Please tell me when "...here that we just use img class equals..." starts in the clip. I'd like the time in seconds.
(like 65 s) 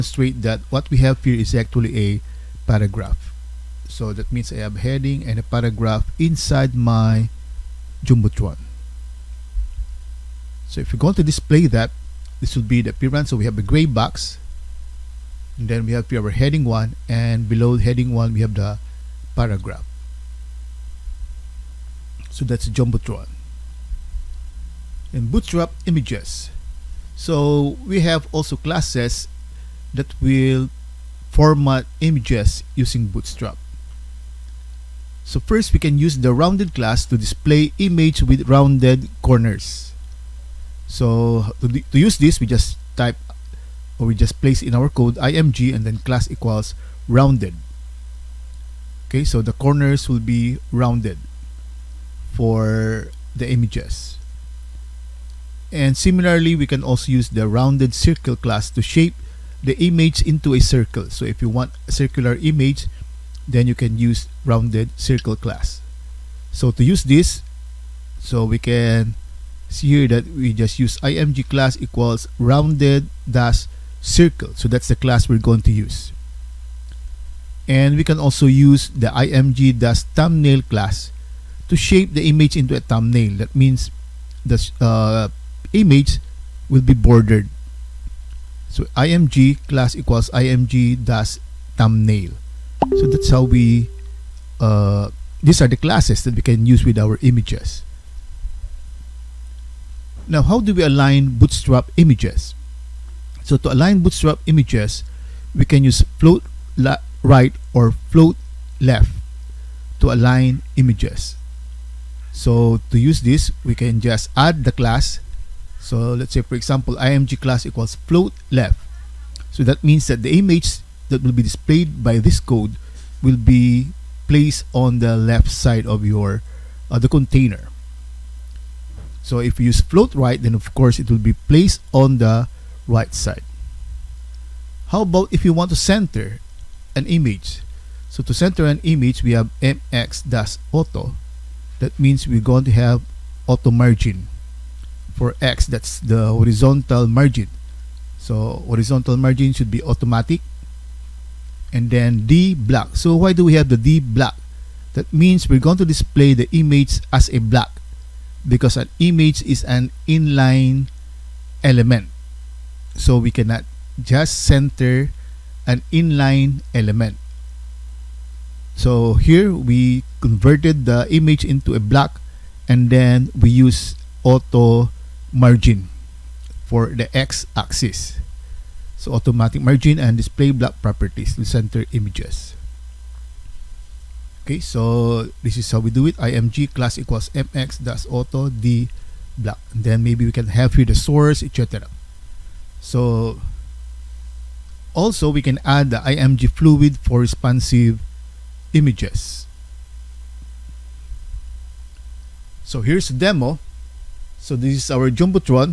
69 s.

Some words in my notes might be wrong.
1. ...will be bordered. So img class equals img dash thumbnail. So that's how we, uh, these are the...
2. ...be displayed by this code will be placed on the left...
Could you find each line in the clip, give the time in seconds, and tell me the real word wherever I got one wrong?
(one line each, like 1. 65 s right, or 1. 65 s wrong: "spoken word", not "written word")
1. 86 s right
2. 121 s right.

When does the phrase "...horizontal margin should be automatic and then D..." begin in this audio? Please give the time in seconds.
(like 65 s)
148 s.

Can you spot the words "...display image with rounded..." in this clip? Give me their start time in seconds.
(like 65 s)
37 s.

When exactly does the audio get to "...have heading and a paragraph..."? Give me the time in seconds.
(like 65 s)
4 s.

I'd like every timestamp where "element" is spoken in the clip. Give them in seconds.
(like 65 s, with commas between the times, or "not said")
161 s, 166 s.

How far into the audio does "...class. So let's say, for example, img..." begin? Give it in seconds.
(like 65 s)
114 s.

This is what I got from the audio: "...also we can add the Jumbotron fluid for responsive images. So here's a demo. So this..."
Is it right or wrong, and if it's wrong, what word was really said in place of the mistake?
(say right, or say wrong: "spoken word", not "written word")
wrong: "IMG", not "Jumbotron".